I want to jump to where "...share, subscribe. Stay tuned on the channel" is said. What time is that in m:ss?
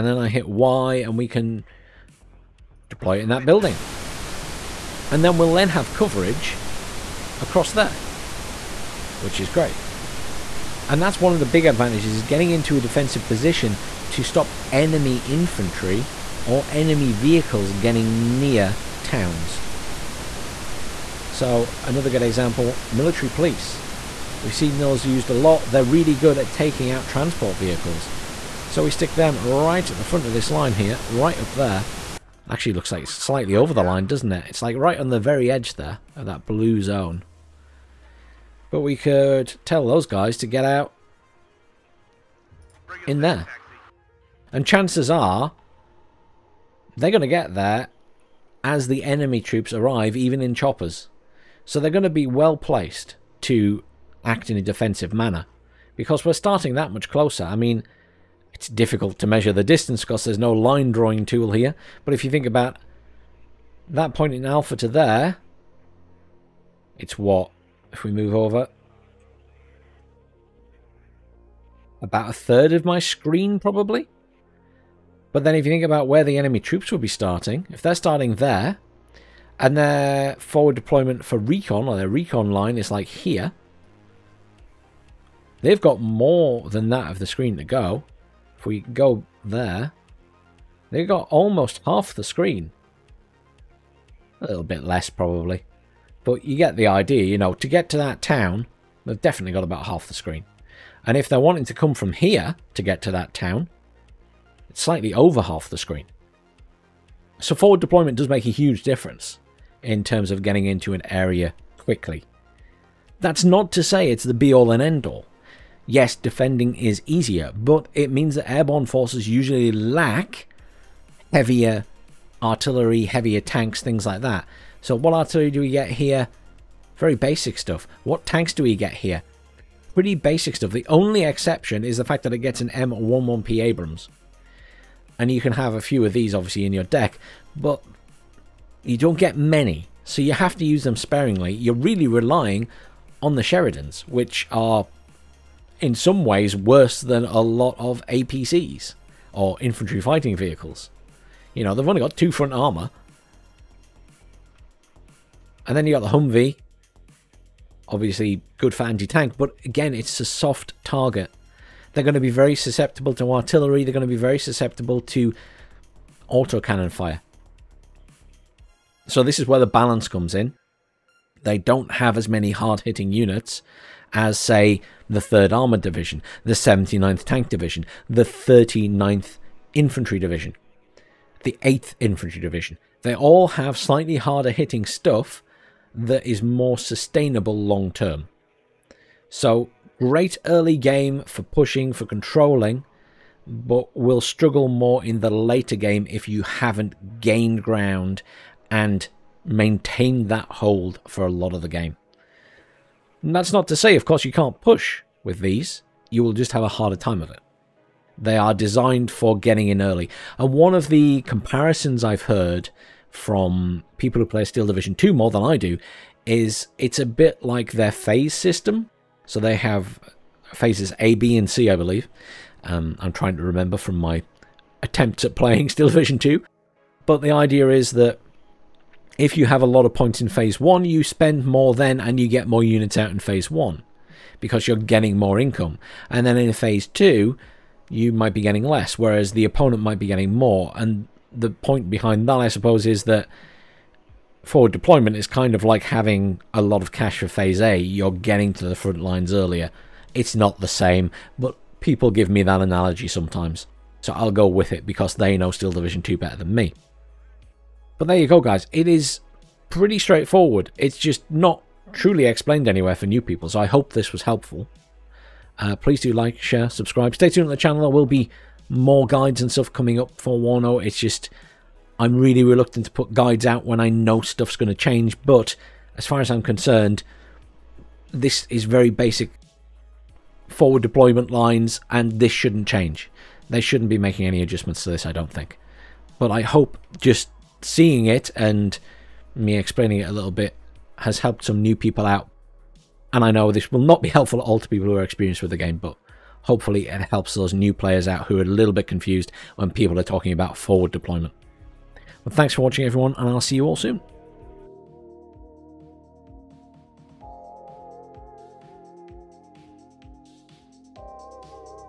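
4:26.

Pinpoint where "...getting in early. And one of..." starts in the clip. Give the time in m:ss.
3:29.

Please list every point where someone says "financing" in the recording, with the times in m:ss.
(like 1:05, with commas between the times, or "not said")
not said.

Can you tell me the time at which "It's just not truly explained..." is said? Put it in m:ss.
4:20.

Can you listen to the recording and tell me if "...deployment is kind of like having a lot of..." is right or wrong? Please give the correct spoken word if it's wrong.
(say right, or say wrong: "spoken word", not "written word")
right.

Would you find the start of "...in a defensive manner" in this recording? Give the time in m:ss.
0:54.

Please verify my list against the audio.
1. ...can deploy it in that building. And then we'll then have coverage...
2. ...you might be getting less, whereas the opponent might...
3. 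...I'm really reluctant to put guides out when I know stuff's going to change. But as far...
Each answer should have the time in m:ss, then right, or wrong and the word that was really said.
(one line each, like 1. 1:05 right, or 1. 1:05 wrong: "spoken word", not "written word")
1. 0:01 right
2. 3:57 right
3. 4:31 right.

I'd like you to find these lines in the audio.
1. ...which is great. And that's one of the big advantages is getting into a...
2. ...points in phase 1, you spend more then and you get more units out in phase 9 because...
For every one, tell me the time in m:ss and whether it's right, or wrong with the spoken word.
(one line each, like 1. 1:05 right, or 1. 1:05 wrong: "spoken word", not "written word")
1. 0:09 right
2. 3:49 wrong: "1", not "9".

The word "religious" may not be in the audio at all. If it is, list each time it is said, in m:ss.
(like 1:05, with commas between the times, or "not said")
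not said.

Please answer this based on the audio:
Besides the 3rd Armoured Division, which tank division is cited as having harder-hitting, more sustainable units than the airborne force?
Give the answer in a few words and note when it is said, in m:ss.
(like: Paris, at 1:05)
79th Tank Division, at 2:56.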